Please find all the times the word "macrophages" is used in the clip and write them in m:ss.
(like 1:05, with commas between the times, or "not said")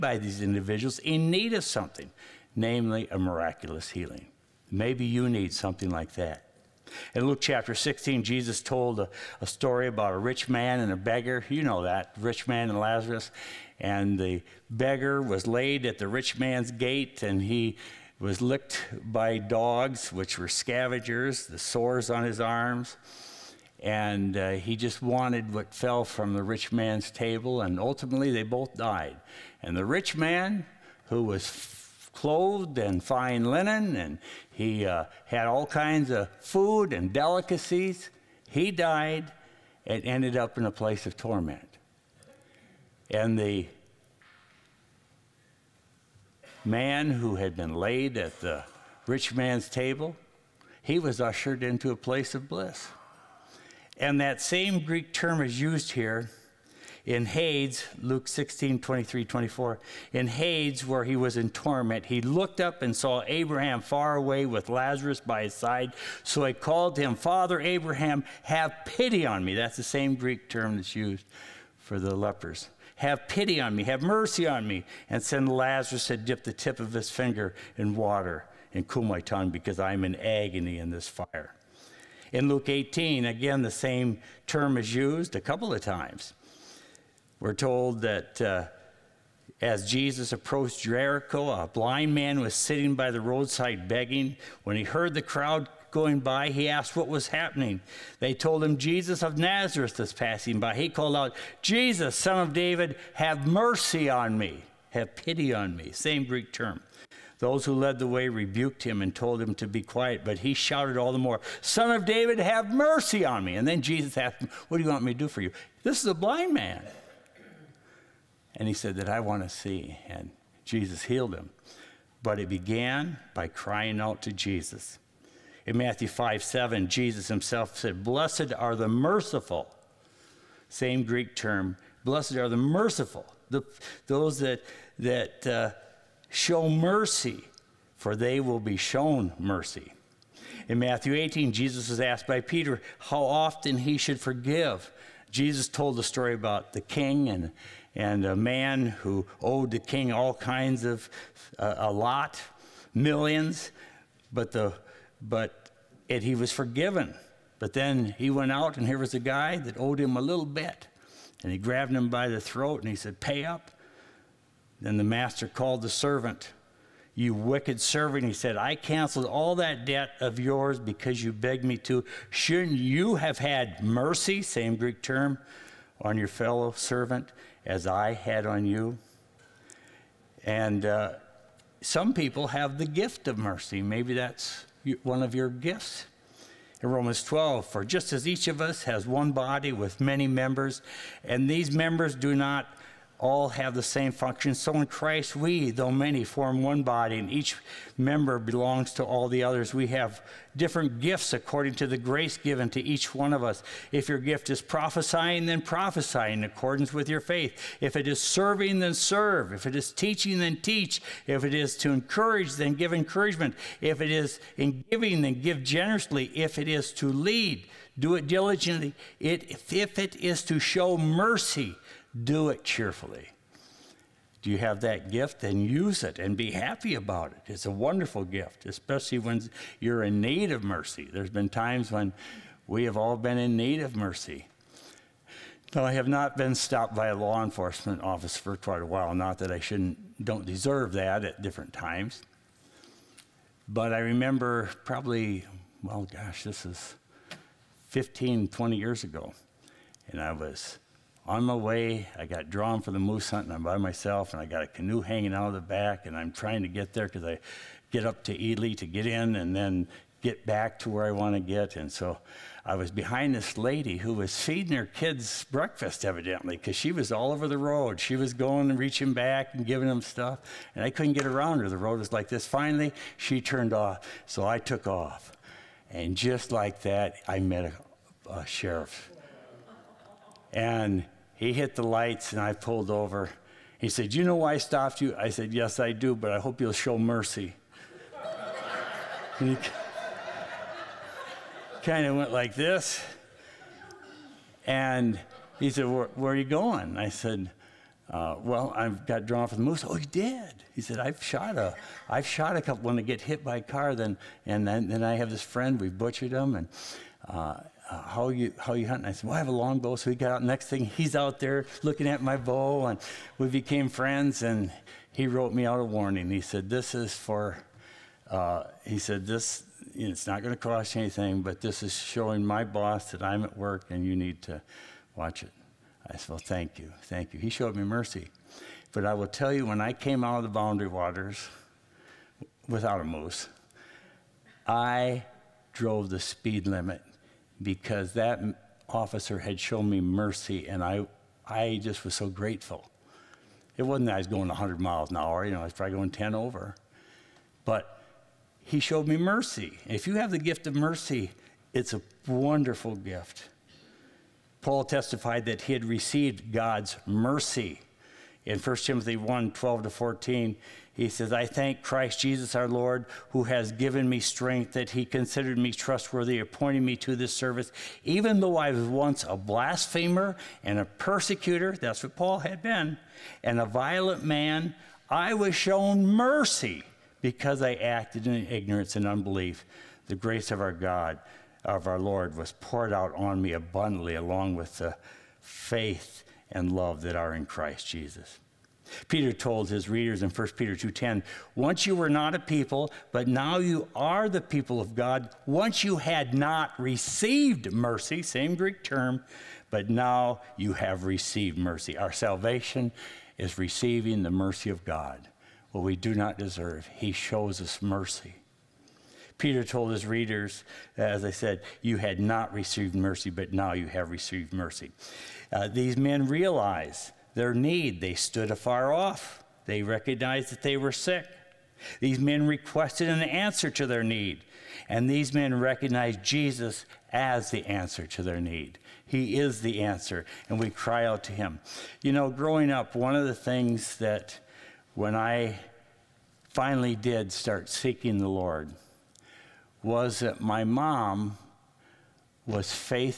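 not said.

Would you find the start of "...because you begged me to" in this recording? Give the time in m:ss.
2:50.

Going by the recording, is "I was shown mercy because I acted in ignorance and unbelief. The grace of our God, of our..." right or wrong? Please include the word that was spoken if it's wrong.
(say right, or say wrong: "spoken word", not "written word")
right.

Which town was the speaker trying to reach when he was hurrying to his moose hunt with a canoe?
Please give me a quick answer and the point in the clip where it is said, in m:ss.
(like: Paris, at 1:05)
Ely, at 4:18.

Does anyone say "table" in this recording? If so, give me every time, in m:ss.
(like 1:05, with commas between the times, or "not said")
0:27, 0:49.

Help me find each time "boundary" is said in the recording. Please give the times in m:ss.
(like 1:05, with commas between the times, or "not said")
5:30.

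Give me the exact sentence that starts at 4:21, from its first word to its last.
And so I was behind this lady who was feeding her kids breakfast, evidently, because she was all over the road.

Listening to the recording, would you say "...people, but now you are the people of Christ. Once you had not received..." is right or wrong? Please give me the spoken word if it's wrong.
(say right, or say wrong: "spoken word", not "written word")
wrong: "God", not "Christ".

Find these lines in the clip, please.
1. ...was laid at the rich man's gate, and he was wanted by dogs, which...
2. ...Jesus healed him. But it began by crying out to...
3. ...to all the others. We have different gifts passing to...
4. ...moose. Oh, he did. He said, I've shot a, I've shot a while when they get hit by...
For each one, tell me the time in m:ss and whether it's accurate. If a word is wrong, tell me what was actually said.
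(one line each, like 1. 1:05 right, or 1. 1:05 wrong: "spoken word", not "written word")
1. 0:15 wrong: "licked", not "wanted"
2. 2:00 right
3. 3:18 wrong: "according", not "passing"
4. 4:59 wrong: "couple", not "while".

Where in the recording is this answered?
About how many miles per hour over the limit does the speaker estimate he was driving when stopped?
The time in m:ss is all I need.
5:46.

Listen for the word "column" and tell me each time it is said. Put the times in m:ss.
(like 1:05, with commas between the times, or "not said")
not said.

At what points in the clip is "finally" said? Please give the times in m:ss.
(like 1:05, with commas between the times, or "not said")
4:32, 7:16.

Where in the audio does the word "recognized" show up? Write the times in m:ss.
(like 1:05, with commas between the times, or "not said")
6:59, 7:05.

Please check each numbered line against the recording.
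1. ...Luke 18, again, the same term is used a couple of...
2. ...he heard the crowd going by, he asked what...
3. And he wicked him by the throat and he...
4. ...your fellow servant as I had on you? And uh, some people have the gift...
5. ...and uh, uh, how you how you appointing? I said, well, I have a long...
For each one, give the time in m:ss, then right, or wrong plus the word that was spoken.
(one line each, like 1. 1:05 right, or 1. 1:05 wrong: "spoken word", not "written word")
1. 1:22 right
2. 1:34 right
3. 2:41 wrong: "grabbed", not "wicked"
4. 2:56 right
5. 5:06 wrong: "hunting", not "appointing".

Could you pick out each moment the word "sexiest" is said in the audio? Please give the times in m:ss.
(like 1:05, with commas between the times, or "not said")
not said.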